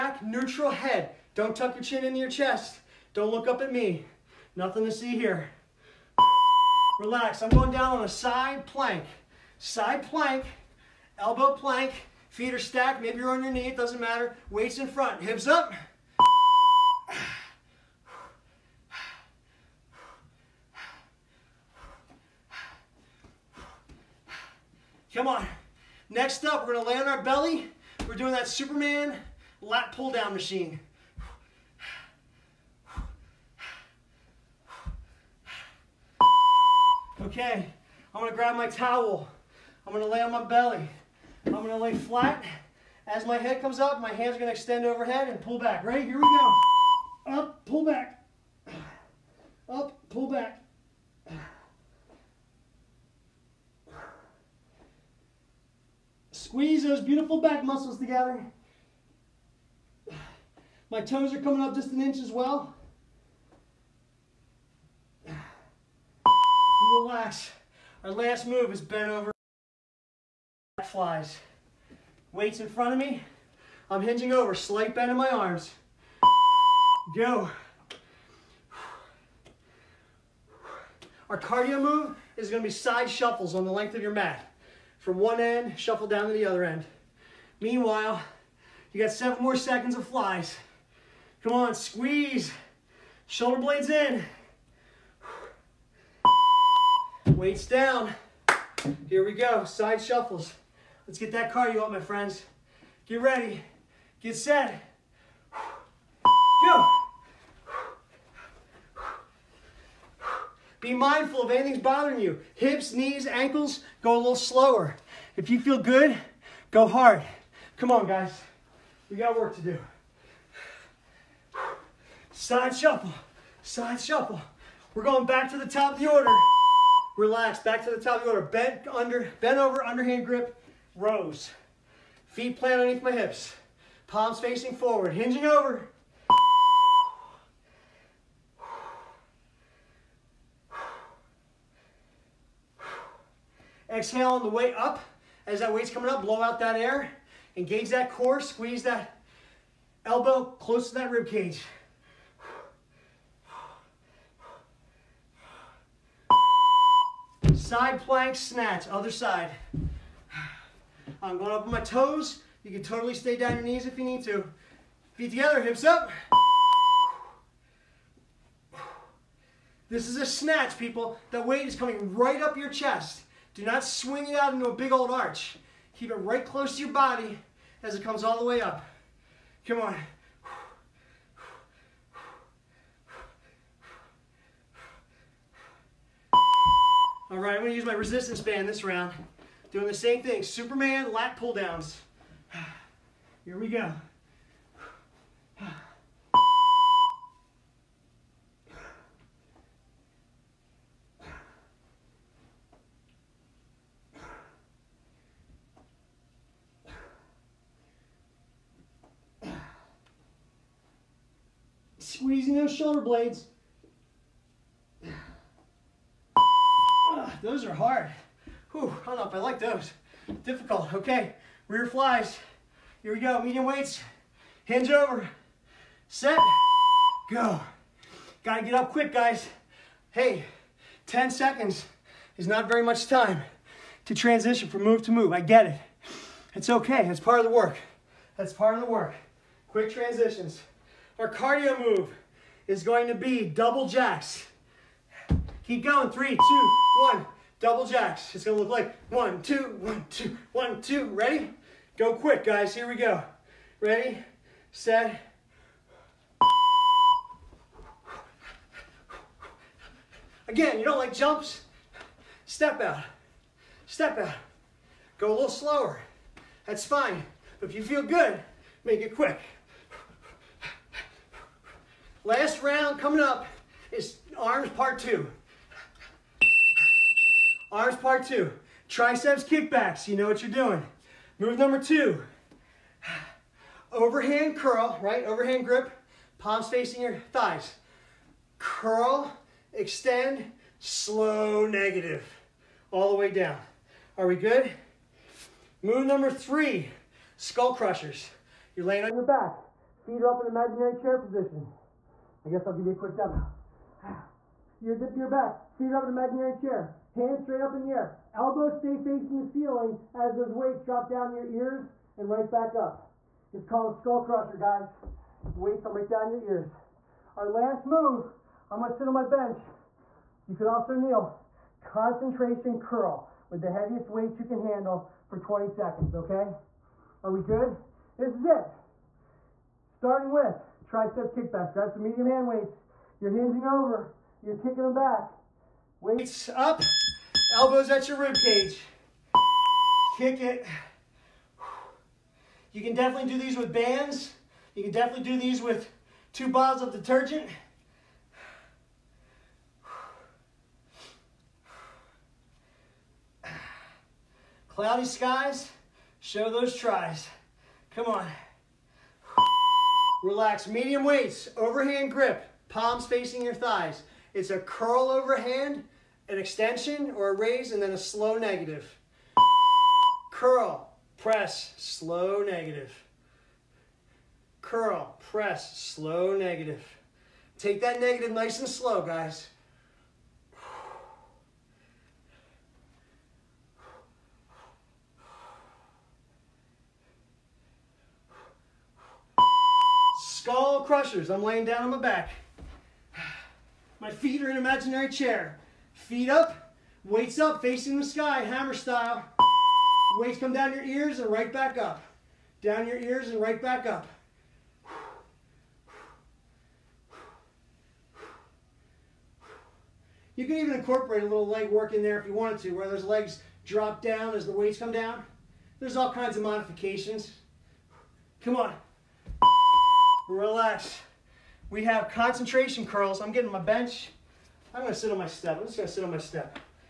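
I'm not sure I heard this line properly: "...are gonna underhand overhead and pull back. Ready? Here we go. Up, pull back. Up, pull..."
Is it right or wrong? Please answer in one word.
wrong.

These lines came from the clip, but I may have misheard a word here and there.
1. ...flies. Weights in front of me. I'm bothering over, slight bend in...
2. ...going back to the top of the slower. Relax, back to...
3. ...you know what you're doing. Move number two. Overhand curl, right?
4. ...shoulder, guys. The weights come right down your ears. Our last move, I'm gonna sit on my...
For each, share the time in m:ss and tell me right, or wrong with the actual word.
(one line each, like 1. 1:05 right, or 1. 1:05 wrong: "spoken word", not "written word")
1. 1:10 wrong: "hinging", not "bothering"
2. 2:05 wrong: "order", not "slower"
3. 4:40 right
4. 5:14 wrong: "crusher", not "shoulder".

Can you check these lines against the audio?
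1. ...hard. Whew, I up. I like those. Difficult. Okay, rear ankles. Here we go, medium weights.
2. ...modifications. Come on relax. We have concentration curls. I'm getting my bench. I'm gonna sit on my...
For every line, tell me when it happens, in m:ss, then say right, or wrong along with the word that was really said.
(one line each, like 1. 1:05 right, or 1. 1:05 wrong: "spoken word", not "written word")
1. 3:37 wrong: "flies", not "ankles"
2. 6:56 right.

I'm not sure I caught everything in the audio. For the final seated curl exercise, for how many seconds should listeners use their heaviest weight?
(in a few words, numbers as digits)
20.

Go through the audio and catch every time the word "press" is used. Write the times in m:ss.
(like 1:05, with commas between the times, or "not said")
6:11, 6:15.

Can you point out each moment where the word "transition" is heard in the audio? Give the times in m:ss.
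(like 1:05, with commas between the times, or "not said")
3:54, 3:59.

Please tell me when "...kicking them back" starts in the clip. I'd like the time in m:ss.
5:34.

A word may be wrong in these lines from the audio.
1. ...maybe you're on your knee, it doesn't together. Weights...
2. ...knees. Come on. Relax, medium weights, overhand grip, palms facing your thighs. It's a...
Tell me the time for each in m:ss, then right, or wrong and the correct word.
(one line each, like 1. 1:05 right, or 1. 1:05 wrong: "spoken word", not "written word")
1. 0:13 wrong: "matter", not "together"
2. 5:56 wrong: "tries", not "knees".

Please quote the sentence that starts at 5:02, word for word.
I guess I'll give you a quick demo.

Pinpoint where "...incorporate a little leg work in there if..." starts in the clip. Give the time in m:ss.
6:50.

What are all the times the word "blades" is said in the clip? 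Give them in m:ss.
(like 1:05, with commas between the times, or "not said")
1:33, 3:33.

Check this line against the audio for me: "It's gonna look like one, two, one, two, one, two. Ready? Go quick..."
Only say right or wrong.
right.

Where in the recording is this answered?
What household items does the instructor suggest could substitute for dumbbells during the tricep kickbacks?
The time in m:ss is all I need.
5:46.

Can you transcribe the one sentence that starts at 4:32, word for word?
Last round coming up is arms part two.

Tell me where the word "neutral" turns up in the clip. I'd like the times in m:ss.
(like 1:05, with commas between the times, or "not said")
0:00.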